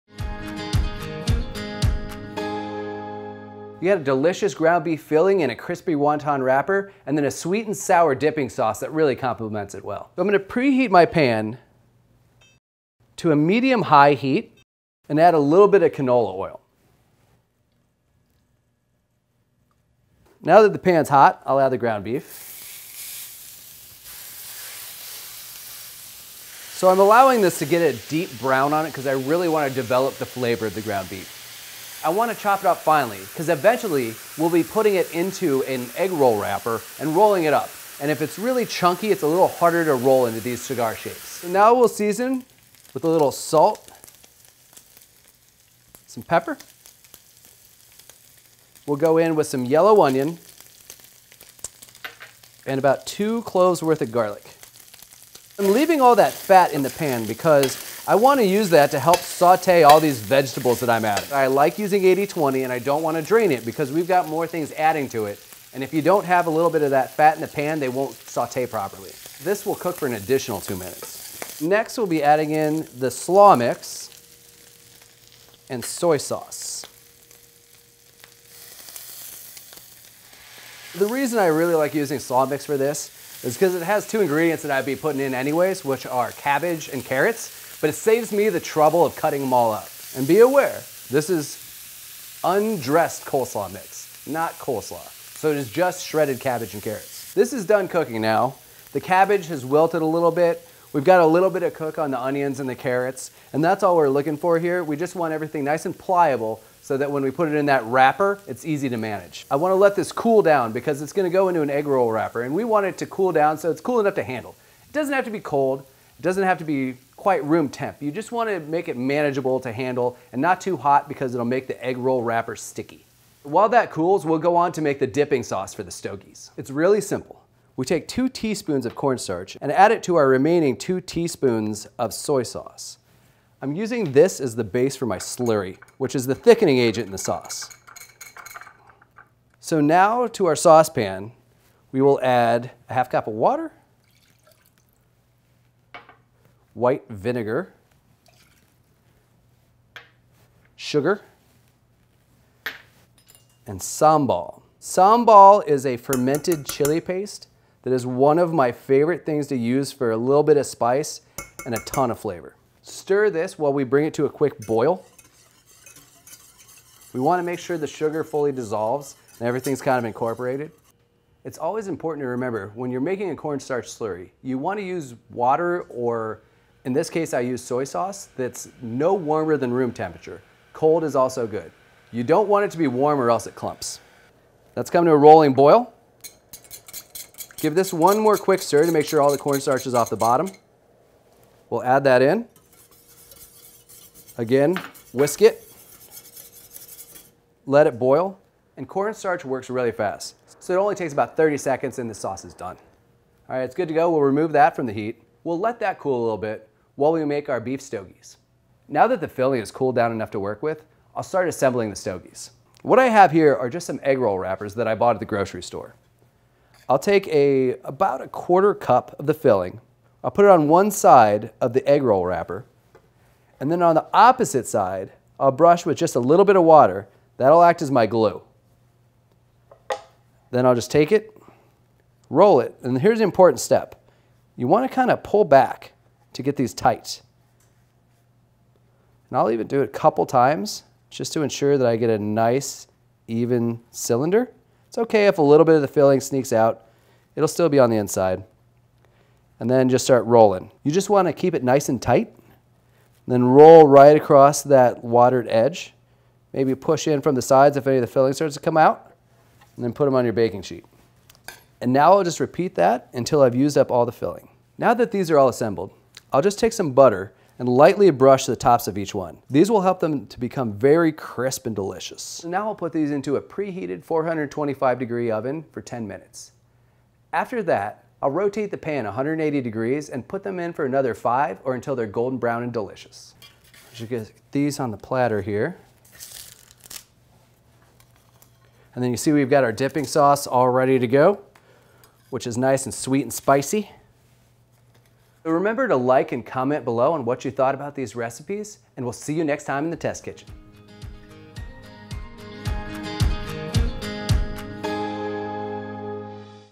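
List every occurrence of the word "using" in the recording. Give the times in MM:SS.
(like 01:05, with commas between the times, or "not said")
01:01, 01:21, 02:13.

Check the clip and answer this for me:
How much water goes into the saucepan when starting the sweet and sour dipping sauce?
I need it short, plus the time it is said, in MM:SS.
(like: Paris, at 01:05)
half cup, at 02:22.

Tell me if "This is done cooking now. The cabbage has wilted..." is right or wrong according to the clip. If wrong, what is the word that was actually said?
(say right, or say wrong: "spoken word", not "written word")
right.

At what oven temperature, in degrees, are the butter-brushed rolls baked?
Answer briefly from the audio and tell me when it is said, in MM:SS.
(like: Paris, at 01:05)
425, at 04:34.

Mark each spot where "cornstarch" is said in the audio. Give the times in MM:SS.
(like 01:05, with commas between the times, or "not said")
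02:08, 02:53, 03:09, 03:18.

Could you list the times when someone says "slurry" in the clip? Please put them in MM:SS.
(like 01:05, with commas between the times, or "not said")
02:15, 02:53.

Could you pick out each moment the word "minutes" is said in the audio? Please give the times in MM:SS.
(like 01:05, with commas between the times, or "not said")
01:10, 04:36.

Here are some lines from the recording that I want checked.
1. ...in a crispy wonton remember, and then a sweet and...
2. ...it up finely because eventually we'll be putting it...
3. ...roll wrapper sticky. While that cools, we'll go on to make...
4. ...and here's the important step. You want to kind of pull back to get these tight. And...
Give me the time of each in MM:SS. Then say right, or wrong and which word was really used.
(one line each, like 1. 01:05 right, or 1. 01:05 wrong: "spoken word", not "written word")
1. 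00:05 wrong: "wrapper", not "remember"
2. 00:32 right
3. 02:01 right
4. 03:52 right.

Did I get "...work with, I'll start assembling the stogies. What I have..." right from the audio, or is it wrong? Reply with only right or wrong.
right.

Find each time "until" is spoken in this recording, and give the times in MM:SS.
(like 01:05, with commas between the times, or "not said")
04:23, 04:41.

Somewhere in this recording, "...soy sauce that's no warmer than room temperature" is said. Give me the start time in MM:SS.
02:57.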